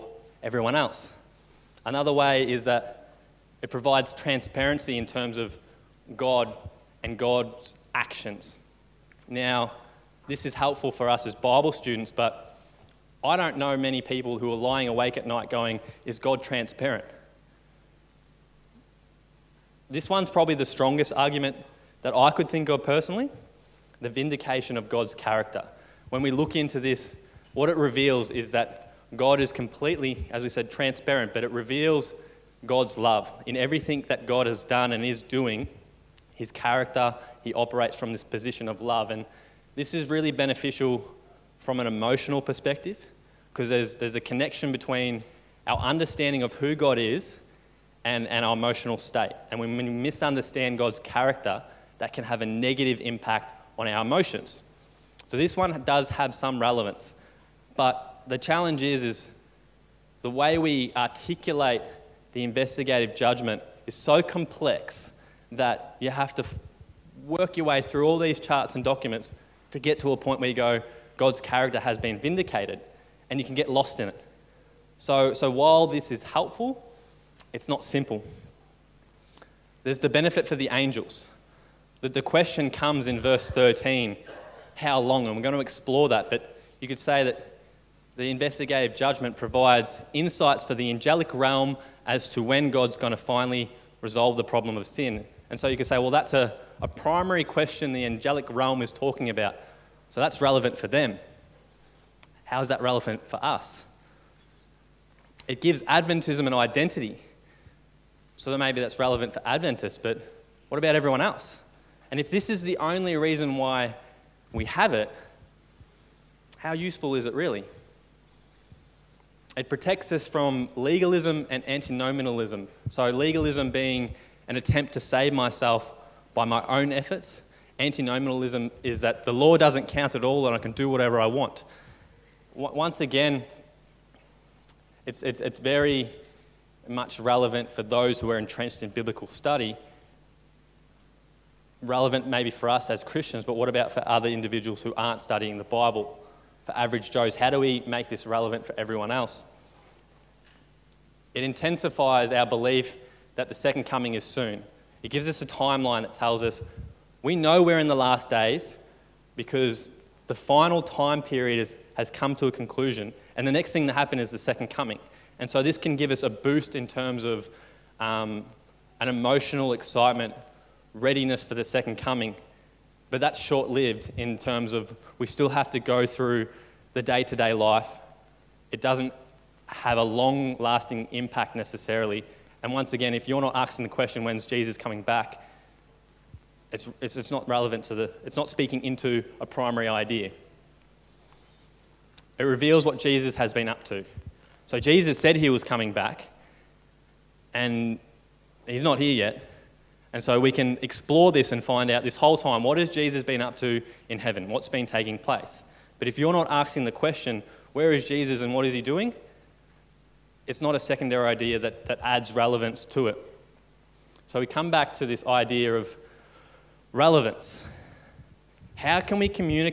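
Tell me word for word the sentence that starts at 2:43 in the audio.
And the next thing that happened is the second coming.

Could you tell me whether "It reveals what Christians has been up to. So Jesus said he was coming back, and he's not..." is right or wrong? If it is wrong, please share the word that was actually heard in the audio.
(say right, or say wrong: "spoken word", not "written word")
wrong: "Jesus", not "Christians".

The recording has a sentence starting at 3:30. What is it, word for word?
it's not a secondary idea that, that adds relevance to it.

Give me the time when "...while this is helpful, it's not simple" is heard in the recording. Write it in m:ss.
1:15.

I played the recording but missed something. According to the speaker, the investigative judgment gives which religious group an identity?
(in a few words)
Adventism.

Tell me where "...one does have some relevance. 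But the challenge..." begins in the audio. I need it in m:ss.
0:55.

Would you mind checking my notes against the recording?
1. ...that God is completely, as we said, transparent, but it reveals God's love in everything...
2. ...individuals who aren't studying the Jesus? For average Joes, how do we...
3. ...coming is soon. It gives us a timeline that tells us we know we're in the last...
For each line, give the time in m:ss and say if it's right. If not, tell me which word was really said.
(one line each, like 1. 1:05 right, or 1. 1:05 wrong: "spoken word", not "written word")
1. 0:28 right
2. 2:24 wrong: "Bible", not "Jesus"
3. 2:33 right.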